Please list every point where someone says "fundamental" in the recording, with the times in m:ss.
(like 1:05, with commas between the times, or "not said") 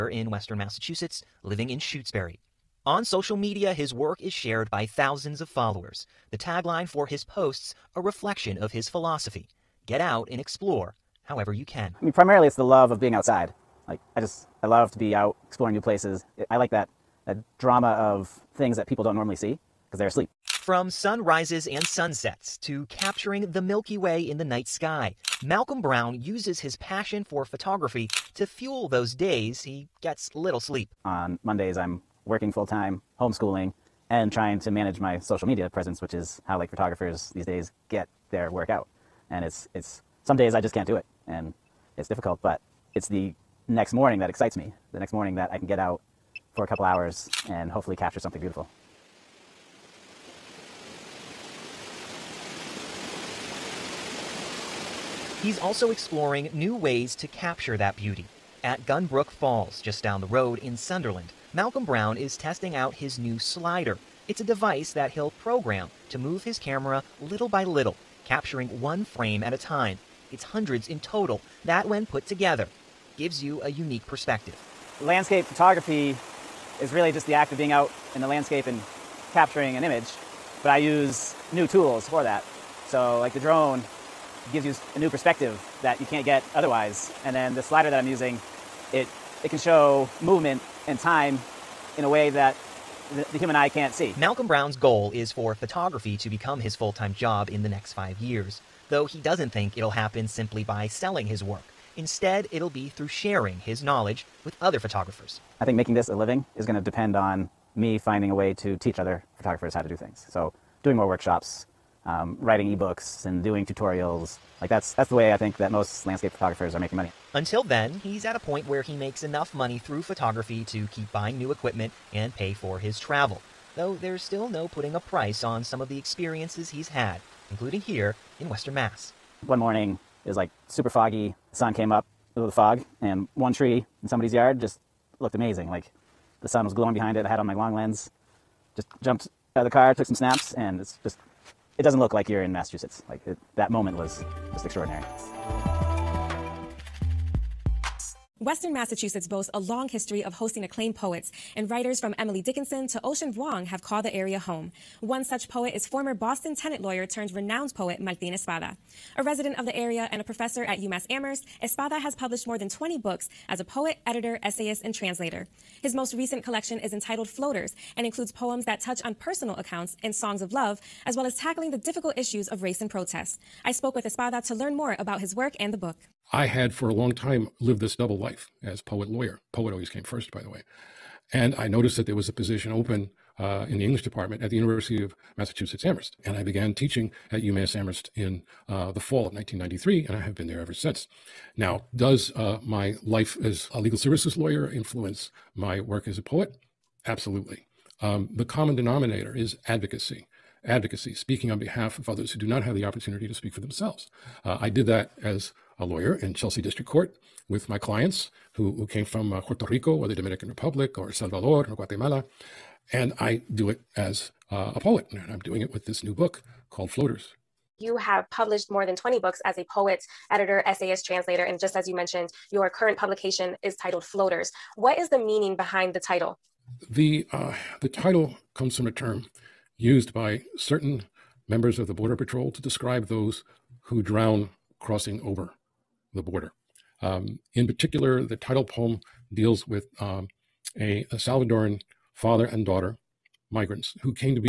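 not said.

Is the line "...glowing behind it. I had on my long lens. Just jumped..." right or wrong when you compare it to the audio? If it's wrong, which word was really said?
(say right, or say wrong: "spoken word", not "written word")
right.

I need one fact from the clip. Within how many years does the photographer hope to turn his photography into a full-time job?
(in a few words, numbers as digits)
5.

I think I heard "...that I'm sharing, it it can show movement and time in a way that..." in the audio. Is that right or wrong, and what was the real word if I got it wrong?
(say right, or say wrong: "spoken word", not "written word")
wrong: "using", not "sharing".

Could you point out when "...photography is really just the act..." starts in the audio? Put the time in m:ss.
1:15.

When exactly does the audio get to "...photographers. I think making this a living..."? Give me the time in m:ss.
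1:44.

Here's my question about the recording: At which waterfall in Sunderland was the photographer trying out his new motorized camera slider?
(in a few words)
Gunbrook Falls.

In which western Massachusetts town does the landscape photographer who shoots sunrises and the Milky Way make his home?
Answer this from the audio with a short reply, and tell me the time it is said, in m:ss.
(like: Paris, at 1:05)
Shutesbury, at 0:01.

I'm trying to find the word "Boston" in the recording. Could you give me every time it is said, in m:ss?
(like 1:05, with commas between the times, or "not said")
2:36.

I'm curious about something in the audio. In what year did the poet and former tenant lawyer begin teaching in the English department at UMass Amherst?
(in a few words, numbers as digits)
1993.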